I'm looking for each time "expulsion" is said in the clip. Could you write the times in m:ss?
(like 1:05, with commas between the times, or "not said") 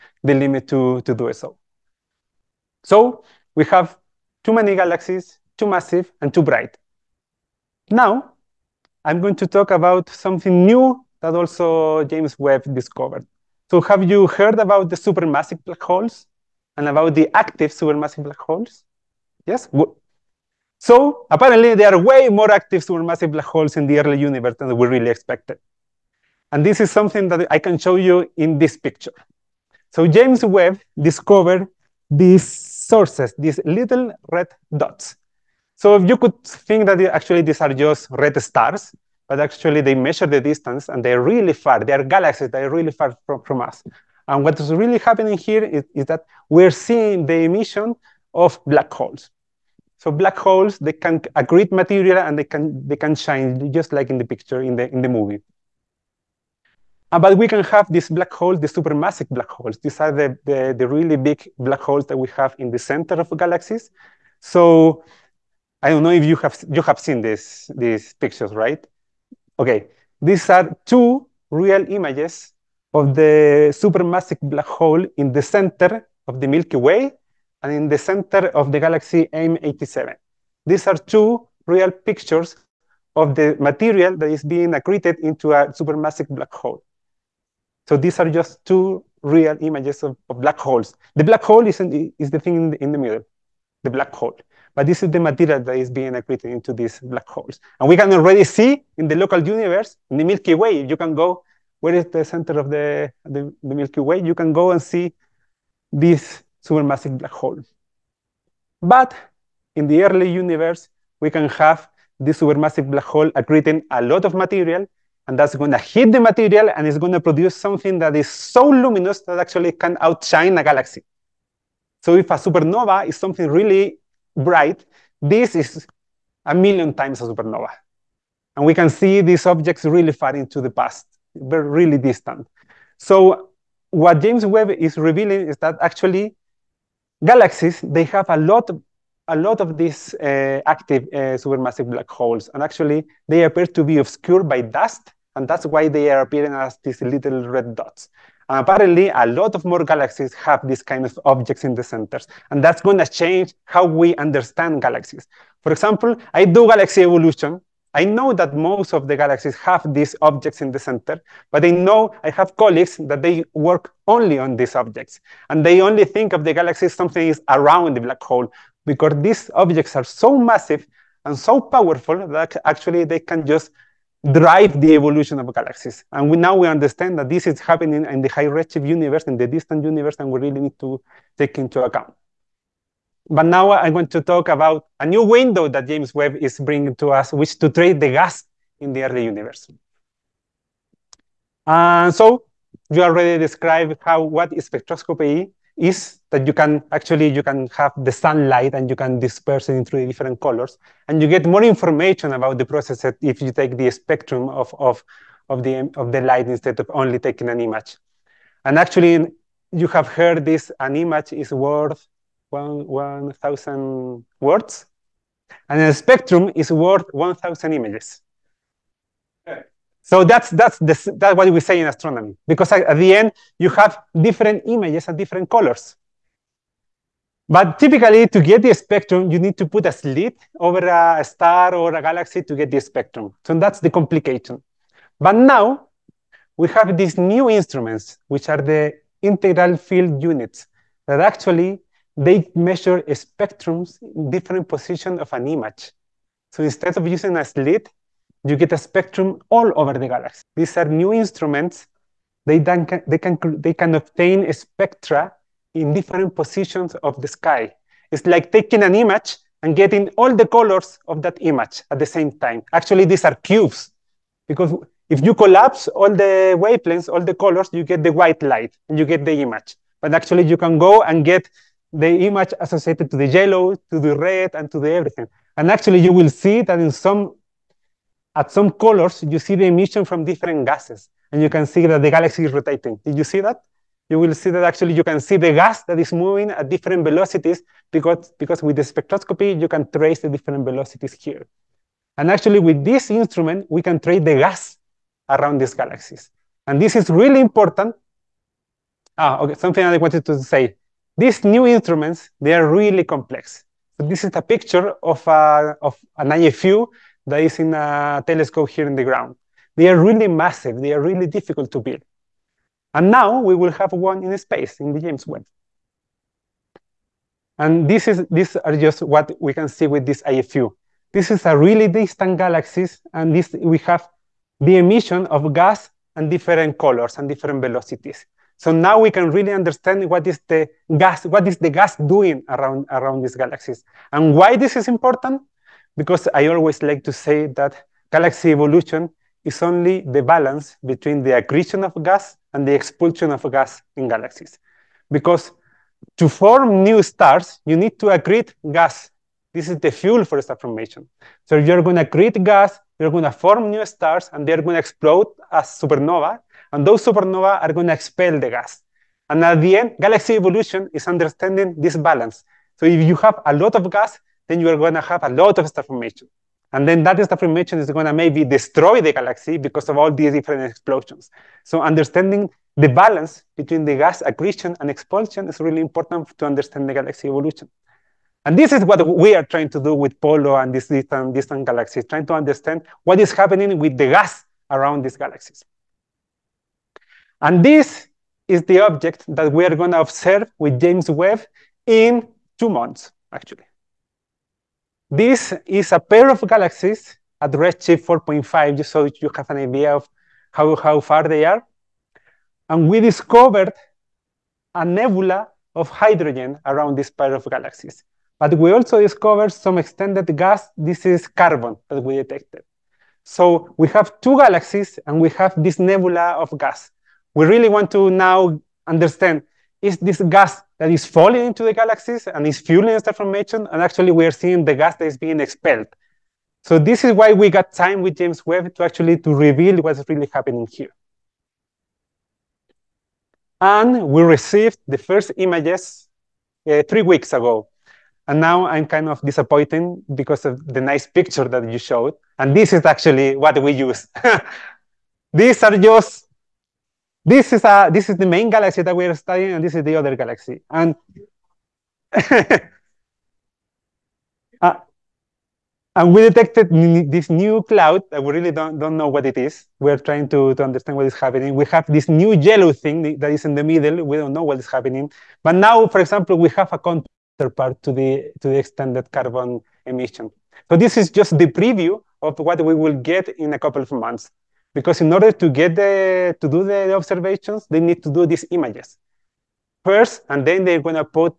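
5:42, 6:14.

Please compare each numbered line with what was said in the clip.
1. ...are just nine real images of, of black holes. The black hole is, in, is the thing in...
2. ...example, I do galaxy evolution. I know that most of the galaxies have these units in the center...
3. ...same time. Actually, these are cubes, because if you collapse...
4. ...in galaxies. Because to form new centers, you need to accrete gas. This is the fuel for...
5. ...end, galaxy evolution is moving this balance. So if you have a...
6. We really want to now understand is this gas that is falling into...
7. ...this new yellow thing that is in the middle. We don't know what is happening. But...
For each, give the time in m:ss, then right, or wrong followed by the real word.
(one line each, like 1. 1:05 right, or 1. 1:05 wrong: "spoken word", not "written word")
1. 1:28 wrong: "two", not "nine"
2. 2:35 wrong: "objects", not "units"
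3. 4:22 right
4. 5:43 wrong: "stars", not "centers"
5. 5:59 wrong: "understanding", not "moving"
6. 6:57 right
7. 7:41 right.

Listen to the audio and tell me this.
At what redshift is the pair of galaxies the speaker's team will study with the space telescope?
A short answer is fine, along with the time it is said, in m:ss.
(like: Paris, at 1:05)
4.5, at 6:37.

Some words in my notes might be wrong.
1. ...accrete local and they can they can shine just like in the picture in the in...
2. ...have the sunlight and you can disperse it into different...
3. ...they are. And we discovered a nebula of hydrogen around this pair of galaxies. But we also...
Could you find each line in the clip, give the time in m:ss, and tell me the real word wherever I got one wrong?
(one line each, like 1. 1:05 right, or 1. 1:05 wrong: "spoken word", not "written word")
1. 0:51 wrong: "material", not "local"
2. 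3:17 right
3. 6:41 right.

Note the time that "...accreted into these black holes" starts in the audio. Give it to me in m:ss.
1:36.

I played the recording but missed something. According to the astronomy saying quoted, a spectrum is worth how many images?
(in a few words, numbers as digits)
1,000.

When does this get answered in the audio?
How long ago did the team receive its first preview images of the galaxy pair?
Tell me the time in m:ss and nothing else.
7:16.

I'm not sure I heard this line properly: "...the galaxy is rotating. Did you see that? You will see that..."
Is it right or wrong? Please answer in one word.
right.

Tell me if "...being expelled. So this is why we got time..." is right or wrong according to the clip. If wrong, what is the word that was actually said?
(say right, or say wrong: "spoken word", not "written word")
right.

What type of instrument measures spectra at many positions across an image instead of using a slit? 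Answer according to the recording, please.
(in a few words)
integral field units.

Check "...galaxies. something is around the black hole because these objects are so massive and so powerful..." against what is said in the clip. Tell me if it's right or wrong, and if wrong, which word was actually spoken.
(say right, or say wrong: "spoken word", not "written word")
right.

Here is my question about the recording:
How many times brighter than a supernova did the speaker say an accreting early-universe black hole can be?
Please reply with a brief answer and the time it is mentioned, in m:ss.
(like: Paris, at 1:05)
a million, at 2:06.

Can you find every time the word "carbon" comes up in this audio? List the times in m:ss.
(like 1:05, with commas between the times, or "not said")
6:51, 7:49.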